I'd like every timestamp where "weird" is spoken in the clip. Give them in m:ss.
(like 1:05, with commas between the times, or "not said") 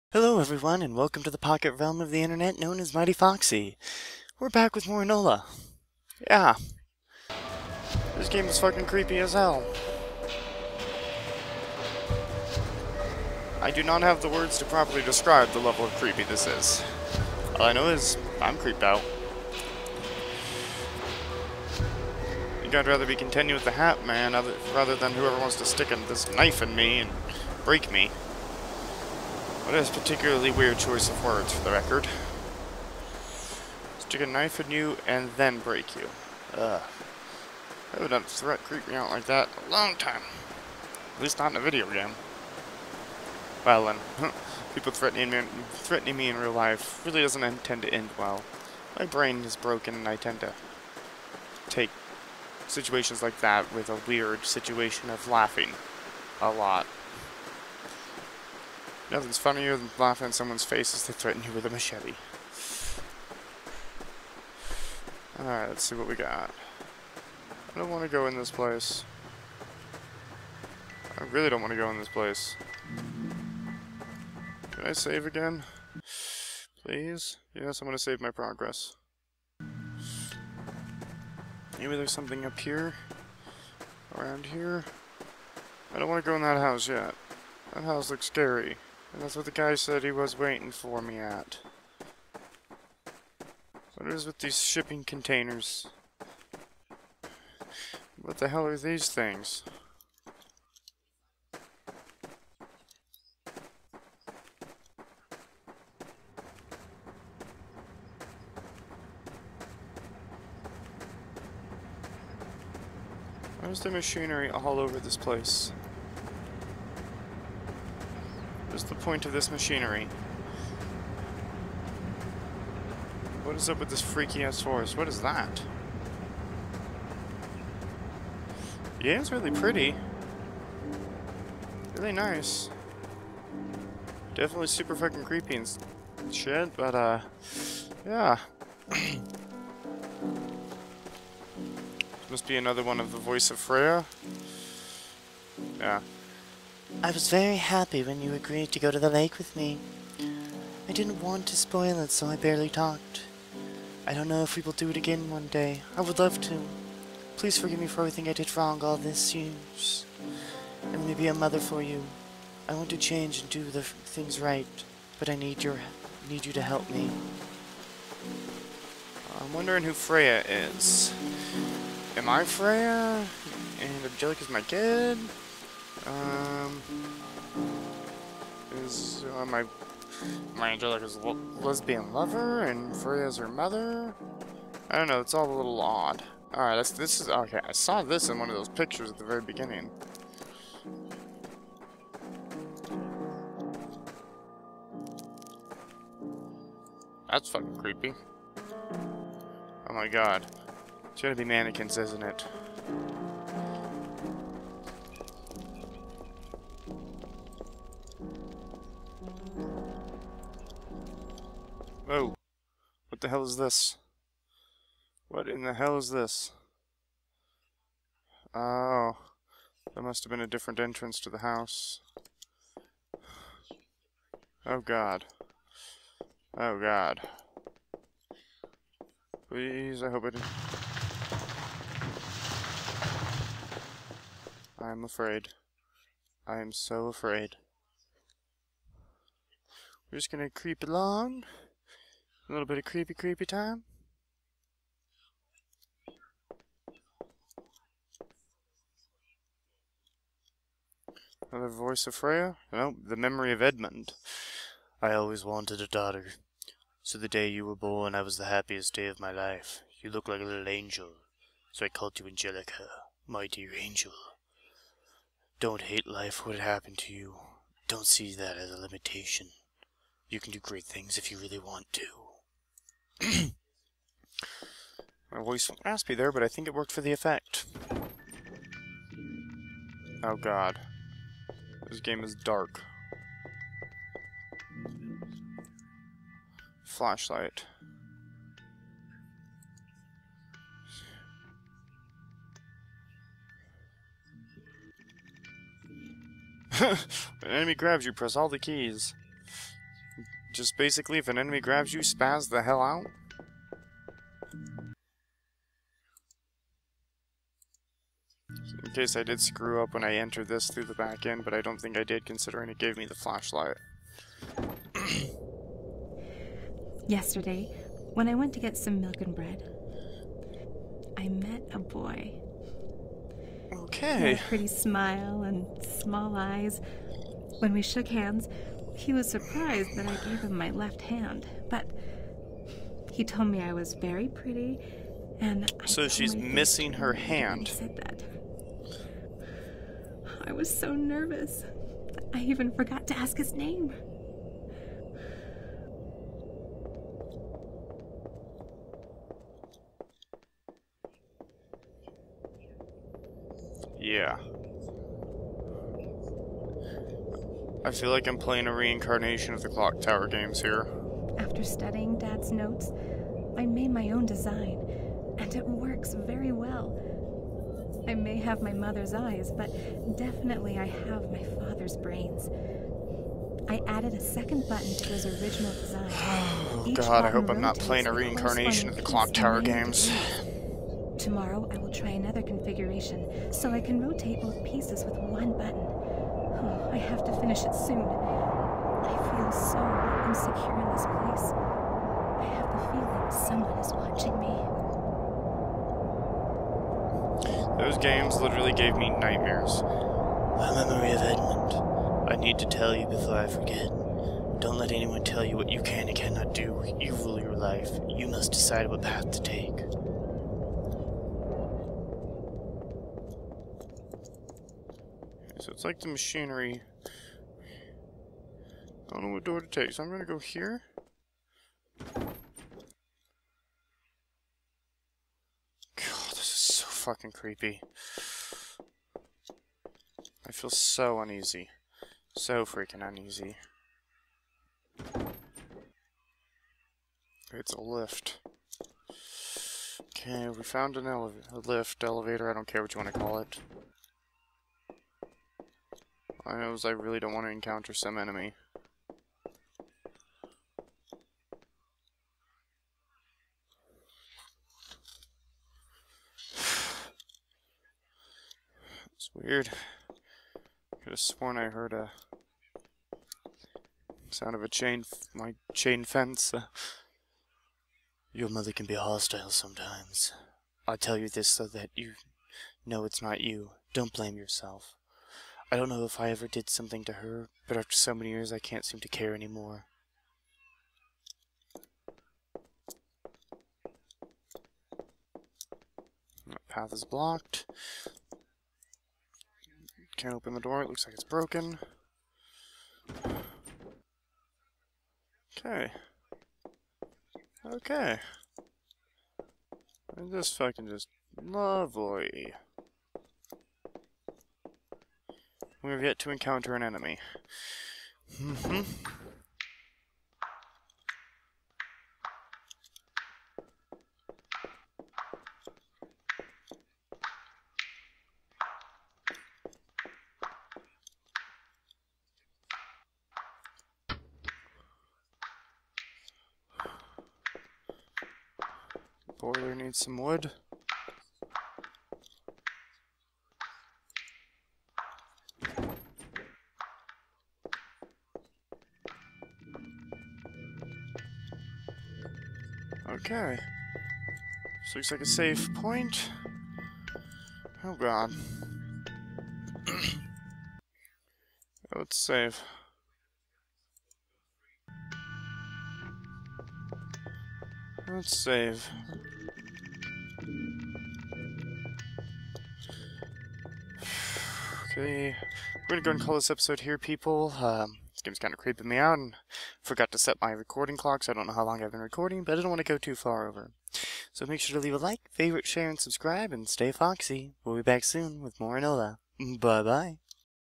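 0:30, 0:54, 7:39.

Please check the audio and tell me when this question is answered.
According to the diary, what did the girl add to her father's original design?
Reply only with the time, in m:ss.
6:14.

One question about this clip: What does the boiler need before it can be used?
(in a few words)
Wood.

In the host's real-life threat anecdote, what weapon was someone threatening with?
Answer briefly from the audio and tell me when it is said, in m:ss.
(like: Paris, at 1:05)
A machete, at 1:01.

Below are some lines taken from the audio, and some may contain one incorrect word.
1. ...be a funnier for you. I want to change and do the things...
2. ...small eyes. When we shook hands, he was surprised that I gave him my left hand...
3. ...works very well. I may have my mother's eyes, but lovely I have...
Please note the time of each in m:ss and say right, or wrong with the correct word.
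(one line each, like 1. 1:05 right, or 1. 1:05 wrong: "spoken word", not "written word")
1. 2:41 wrong: "mother", not "funnier"
2. 5:25 right
3. 6:05 wrong: "definitely", not "lovely".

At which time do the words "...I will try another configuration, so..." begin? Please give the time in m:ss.
6:21.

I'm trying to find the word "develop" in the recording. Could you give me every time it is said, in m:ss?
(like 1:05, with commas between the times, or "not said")
not said.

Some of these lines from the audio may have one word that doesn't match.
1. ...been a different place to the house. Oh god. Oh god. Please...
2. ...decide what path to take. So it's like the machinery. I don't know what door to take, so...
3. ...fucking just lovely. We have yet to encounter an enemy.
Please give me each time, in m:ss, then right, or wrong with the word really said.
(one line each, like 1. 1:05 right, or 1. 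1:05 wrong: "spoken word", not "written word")
1. 3:40 wrong: "entrance", not "place"
2. 6:48 right
3. 8:20 right.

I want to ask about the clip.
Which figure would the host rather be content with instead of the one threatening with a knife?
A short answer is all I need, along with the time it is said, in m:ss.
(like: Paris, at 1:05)
The Hat Man, at 0:23.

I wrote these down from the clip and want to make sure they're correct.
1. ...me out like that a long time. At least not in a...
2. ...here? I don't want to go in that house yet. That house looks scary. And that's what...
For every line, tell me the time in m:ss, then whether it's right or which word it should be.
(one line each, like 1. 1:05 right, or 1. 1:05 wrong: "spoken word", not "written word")
1. 0:38 right
2. 1:24 right.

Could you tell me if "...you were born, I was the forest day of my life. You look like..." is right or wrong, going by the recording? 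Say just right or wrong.
wrong.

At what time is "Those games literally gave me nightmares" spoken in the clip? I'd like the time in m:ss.
6:37.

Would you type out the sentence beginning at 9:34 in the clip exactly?
So make sure to leave a like, favorite, share, and subscribe, and stay foxy.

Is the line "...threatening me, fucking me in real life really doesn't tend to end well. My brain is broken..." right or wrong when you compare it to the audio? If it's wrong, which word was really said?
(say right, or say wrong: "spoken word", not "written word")
wrong: "threatening", not "fucking".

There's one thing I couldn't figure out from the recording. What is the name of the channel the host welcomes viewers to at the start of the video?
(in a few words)
Mighty Foxxy.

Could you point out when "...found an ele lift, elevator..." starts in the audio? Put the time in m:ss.
7:20.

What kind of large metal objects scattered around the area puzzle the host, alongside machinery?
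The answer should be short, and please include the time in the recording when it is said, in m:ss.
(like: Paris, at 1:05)
Shipping containers, at 1:34.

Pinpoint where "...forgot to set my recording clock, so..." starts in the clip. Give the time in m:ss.
9:29.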